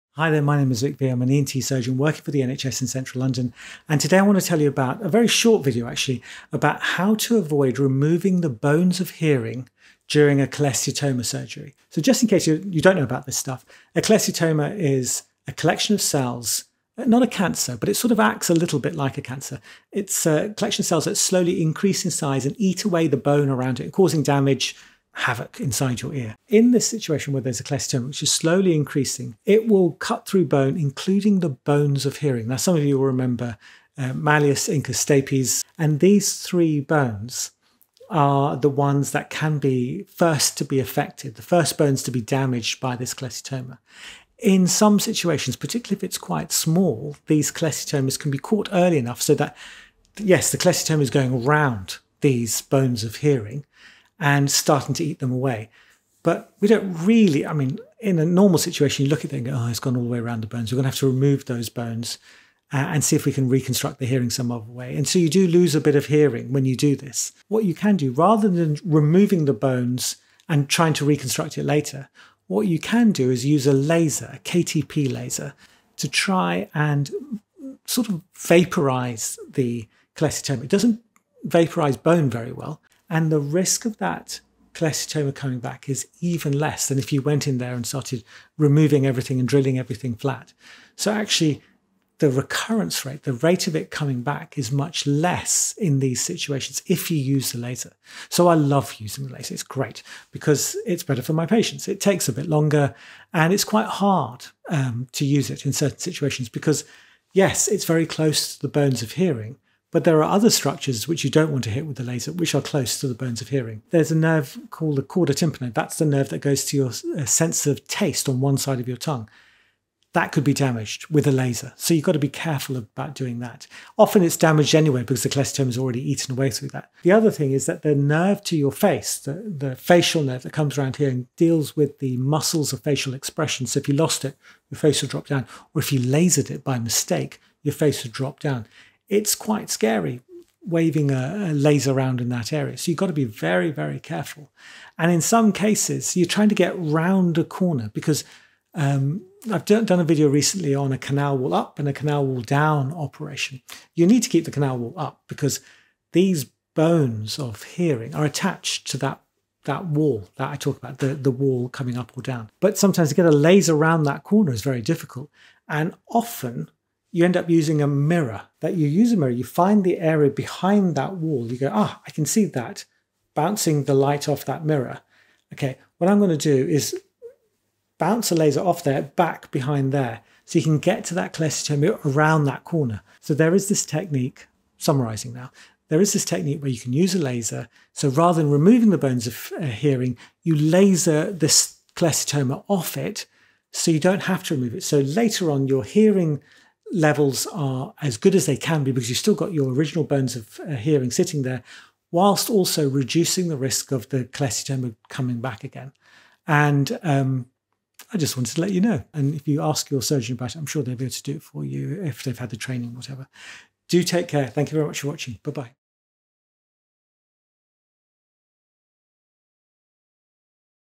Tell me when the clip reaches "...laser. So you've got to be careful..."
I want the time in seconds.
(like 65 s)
121 s.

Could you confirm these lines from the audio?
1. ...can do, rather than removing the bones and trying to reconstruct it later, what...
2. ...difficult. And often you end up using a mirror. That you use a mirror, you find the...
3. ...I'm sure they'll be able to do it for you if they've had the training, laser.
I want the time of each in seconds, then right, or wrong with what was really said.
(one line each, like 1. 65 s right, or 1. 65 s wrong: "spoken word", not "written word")
1. 67 s right
2. 164 s right
3. 210 s wrong: "whatever", not "laser".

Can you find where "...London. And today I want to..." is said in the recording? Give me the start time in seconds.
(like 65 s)
3 s.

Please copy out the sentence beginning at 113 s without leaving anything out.
There's a nerve called the chorda tympani.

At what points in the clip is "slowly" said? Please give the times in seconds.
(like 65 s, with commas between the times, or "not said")
21 s, 28 s.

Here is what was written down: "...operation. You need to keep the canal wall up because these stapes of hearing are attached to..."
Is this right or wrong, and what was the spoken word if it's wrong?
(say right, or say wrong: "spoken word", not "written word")
wrong: "bones", not "stapes".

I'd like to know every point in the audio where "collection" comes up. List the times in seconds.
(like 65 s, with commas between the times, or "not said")
15 s, 20 s.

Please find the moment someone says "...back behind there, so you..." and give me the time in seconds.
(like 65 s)
179 s.